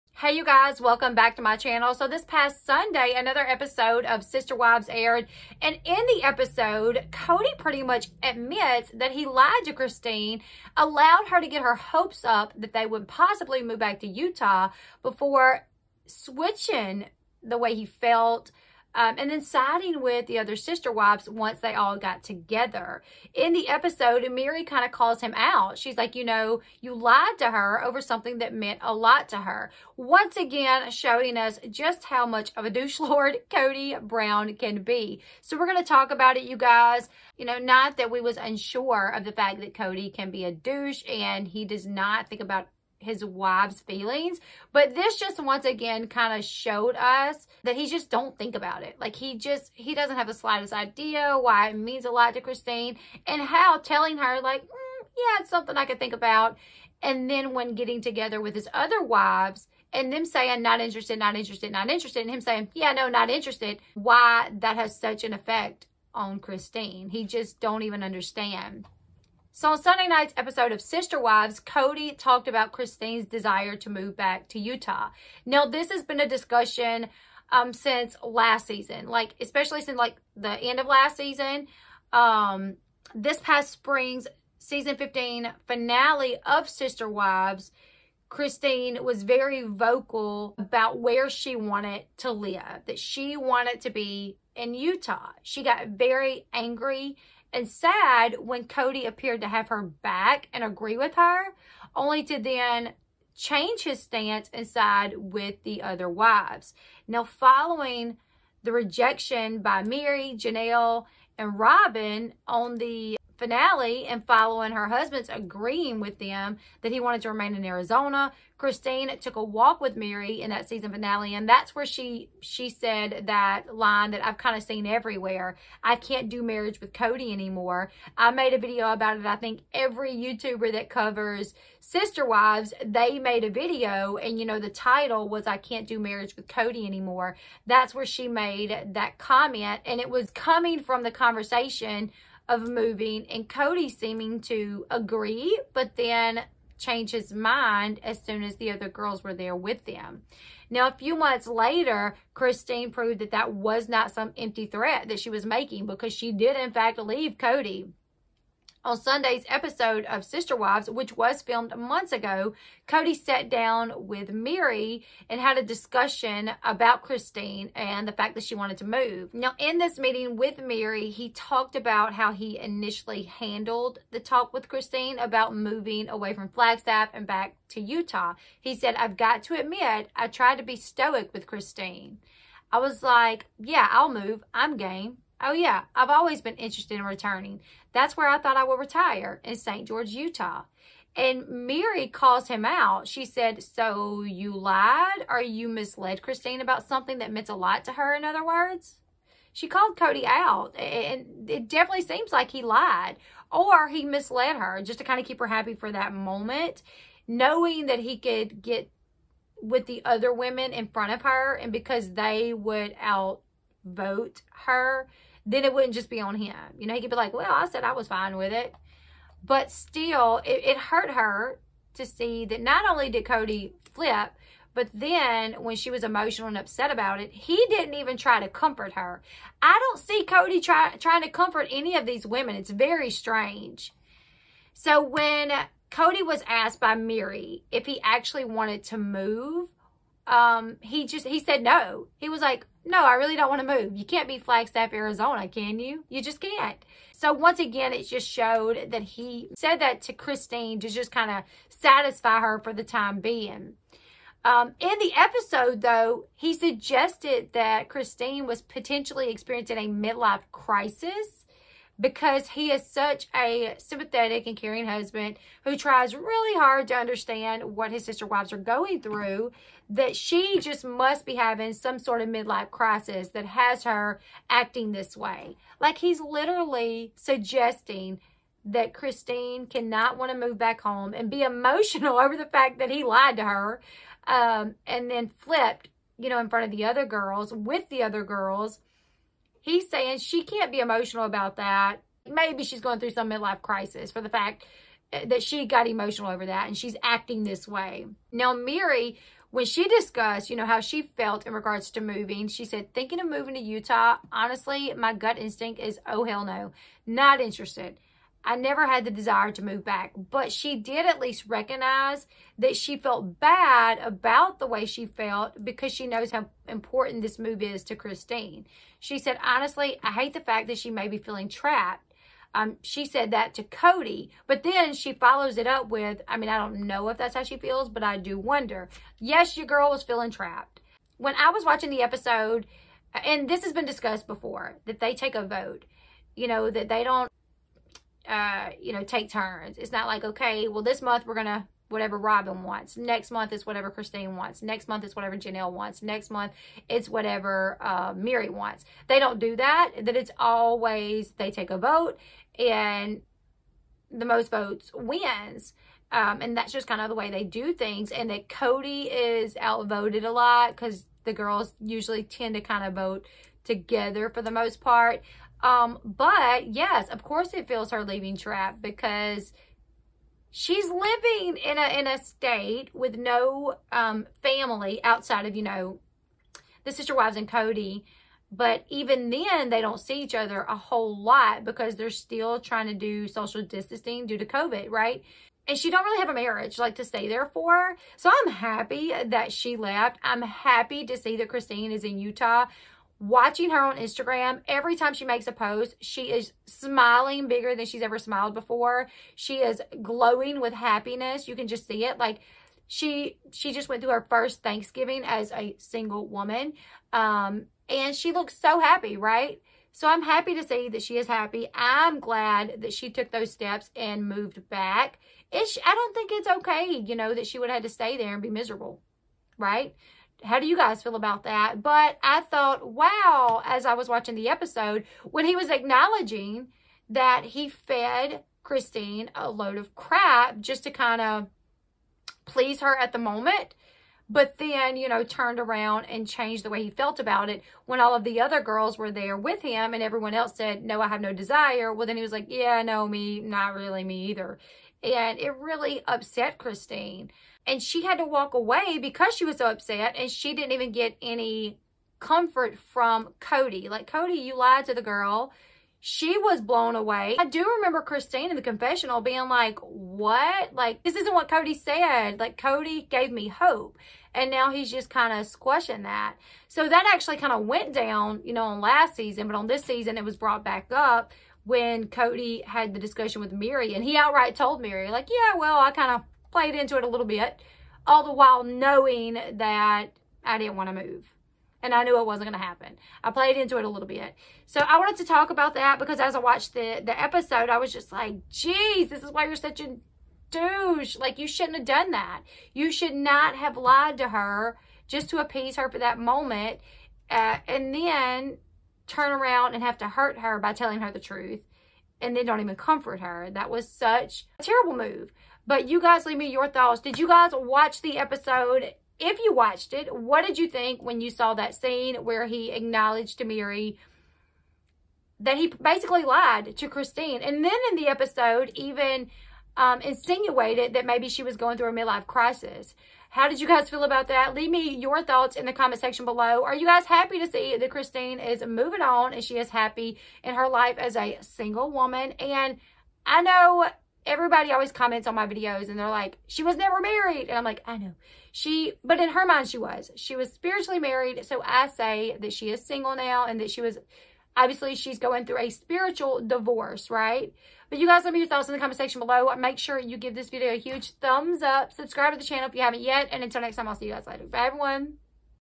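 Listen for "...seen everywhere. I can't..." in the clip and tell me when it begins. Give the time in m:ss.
2:04.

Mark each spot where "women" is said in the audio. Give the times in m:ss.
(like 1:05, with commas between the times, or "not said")
3:30, 3:52.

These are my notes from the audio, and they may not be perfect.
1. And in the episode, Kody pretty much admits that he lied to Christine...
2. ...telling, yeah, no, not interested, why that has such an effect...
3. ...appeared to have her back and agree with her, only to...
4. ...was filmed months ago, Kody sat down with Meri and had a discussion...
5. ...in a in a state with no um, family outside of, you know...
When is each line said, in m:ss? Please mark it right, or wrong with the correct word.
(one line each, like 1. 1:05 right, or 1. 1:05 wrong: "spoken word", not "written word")
1. 0:05 right
2. 1:02 wrong: "saying", not "telling"
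3. 1:39 right
4. 2:41 right
5. 6:11 right.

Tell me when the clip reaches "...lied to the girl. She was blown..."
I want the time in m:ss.
7:34.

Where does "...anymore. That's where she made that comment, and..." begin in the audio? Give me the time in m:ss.
2:16.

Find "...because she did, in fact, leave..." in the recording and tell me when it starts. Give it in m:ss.
2:35.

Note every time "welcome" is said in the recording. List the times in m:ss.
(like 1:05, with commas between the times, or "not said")
0:00.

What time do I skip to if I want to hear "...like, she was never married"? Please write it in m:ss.
8:56.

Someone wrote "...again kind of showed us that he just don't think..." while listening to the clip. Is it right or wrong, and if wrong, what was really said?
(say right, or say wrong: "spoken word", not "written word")
right.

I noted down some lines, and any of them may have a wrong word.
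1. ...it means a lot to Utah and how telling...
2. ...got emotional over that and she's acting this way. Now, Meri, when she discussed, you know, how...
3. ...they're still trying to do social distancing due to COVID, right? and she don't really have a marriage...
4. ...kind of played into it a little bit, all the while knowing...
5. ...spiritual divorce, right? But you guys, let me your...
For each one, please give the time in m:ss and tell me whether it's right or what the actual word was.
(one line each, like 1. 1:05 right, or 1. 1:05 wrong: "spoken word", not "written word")
1. 0:51 wrong: "Christine", not "Utah"
2. 4:55 right
3. 6:21 right
4. 7:55 right
5. 9:05 right.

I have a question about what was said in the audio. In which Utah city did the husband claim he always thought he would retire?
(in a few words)
St. George.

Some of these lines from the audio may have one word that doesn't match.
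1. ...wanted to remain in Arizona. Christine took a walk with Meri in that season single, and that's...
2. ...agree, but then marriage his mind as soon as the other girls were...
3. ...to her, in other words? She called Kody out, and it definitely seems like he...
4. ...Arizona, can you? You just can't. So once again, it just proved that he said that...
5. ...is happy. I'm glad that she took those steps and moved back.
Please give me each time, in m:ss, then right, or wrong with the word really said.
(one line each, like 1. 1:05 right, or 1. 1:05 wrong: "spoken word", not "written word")
1. 1:56 wrong: "finale", not "single"
2. 2:24 wrong: "change", not "marriage"
3. 3:17 right
4. 4:04 wrong: "showed", not "proved"
5. 6:51 right.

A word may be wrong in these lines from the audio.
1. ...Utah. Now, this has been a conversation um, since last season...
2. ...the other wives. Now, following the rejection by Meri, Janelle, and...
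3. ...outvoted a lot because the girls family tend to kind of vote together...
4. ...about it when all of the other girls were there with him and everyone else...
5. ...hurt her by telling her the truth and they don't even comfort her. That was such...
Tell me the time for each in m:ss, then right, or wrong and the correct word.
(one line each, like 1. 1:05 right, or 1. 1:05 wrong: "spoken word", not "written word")
1. 1:14 wrong: "discussion", not "conversation"
2. 1:45 right
3. 5:59 wrong: "usually", not "family"
4. 7:17 right
5. 8:20 right.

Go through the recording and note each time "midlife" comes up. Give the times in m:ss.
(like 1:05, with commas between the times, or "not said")
4:19, 4:32, 4:53, 8:41.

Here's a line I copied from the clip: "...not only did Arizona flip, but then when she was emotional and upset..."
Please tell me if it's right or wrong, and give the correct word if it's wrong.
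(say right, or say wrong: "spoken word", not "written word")
wrong: "Kody", not "Arizona".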